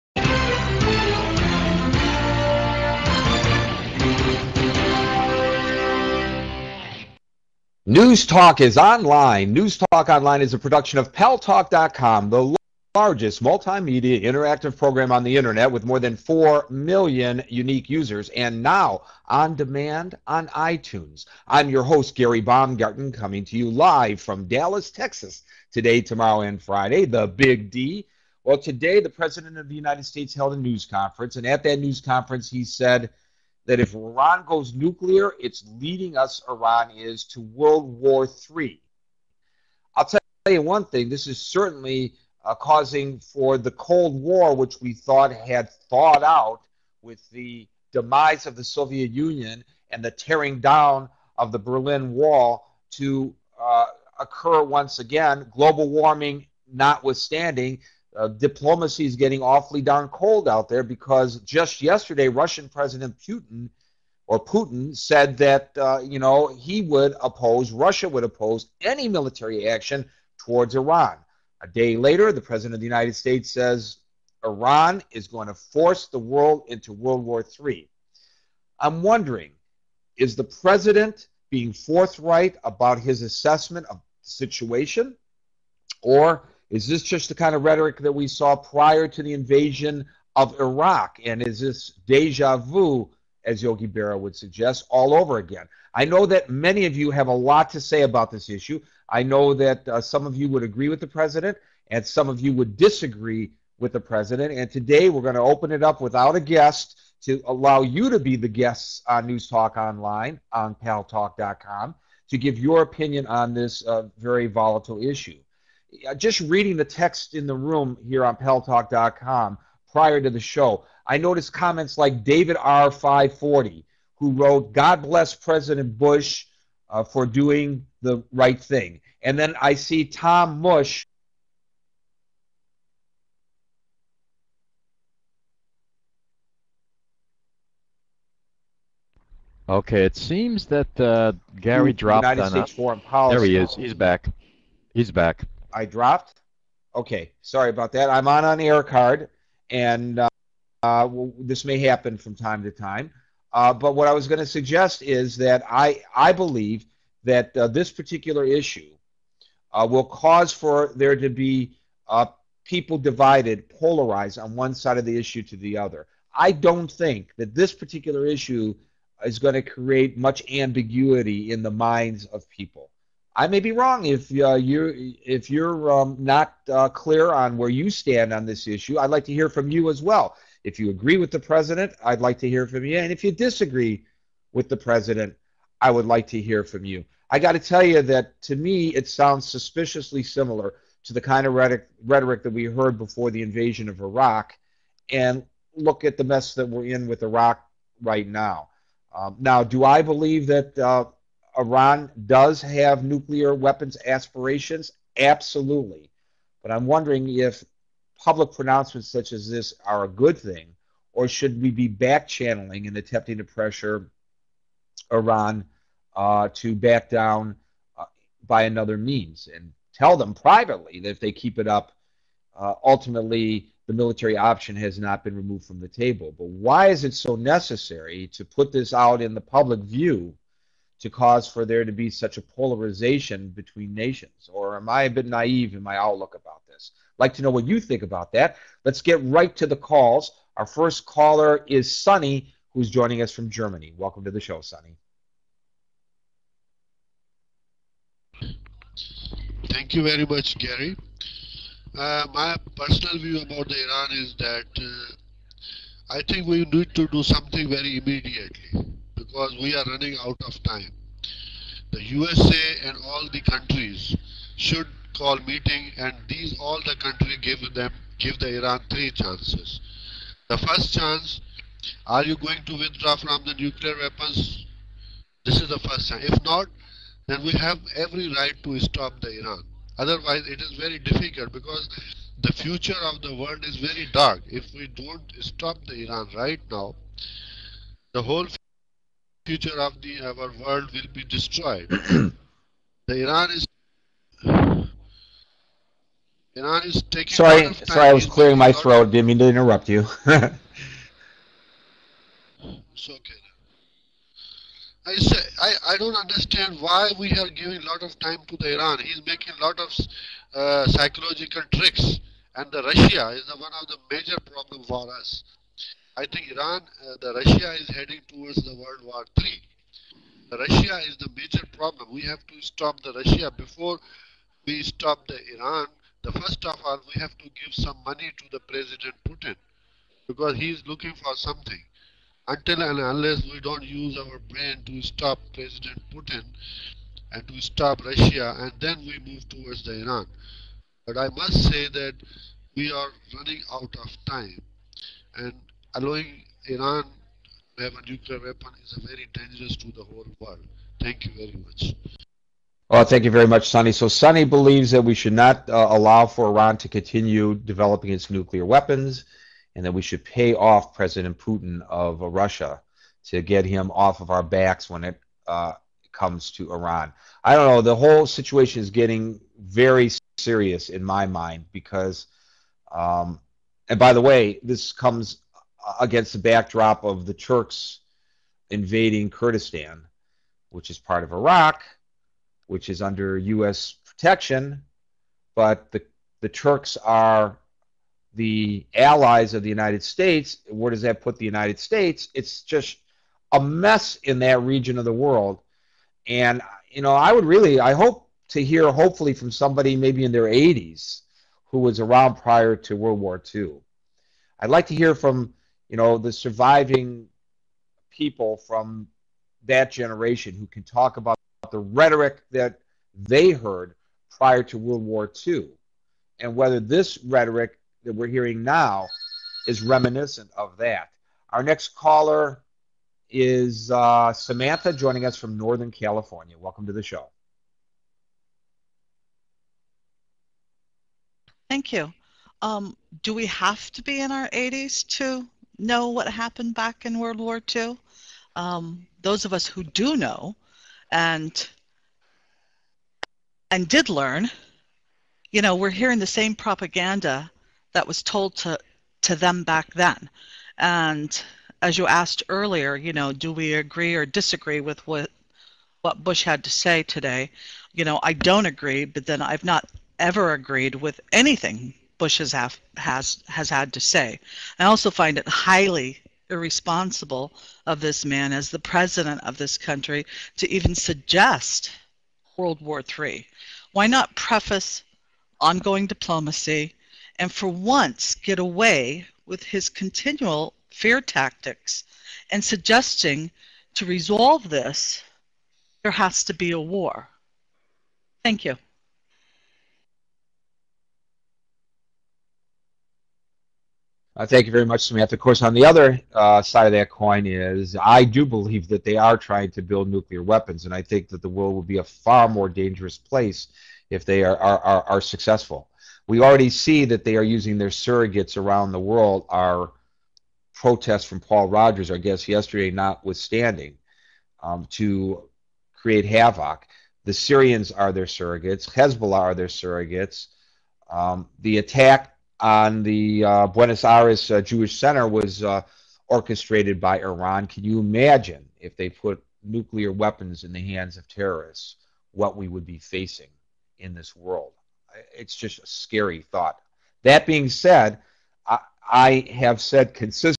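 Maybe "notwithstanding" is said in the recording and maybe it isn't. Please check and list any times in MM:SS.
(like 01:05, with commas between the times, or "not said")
00:56, 08:32.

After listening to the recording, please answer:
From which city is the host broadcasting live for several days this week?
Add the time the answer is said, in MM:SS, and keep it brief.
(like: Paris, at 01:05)
Dallas, Texas, at 00:24.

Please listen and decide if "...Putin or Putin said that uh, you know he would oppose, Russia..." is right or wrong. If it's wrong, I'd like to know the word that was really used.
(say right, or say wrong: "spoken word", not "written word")
right.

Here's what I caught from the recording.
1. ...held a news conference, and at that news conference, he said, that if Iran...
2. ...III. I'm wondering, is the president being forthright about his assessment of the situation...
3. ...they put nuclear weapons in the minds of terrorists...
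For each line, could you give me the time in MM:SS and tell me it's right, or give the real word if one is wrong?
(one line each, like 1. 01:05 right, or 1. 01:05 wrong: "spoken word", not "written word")
1. 00:30 right
2. 01:17 right
3. 08:48 wrong: "hands", not "minds".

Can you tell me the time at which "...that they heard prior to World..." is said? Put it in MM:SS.
06:52.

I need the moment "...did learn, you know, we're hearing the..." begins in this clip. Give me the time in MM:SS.
07:23.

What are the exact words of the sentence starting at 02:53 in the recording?
I may be wrong if uh, you if you're um, not uh, clear on where you stand on this issue.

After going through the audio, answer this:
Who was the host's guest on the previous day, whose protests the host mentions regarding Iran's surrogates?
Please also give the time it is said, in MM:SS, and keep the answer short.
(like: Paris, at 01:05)
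Paul Rogers, at 08:31.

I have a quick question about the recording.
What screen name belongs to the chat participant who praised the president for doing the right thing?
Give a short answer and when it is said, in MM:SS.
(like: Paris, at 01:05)
David R540, at 02:02.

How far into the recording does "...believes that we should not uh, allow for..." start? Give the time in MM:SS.
05:54.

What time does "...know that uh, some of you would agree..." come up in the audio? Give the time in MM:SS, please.
01:39.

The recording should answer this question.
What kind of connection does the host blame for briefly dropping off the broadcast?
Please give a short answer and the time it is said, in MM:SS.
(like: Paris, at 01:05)
air card, at 02:28.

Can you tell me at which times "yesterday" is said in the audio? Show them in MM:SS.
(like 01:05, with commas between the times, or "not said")
01:01, 08:32.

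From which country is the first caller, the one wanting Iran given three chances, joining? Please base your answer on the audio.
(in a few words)
Germany.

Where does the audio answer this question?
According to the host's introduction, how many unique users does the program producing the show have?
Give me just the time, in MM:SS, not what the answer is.
00:15.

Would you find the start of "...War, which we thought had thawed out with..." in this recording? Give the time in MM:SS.
00:44.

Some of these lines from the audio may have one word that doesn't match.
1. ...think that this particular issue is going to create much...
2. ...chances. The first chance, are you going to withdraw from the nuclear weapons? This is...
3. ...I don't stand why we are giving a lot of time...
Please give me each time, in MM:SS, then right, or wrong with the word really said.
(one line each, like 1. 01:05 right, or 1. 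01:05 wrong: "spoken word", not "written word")
1. 02:46 right
2. 04:29 right
3. 05:05 wrong: "understand", not "stand".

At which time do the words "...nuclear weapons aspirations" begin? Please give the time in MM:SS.
03:23.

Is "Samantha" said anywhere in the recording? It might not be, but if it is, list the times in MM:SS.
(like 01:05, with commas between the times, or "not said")
07:04, 08:15.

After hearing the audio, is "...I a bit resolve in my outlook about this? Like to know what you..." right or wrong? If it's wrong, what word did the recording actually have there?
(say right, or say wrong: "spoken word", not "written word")
wrong: "naive", not "resolve".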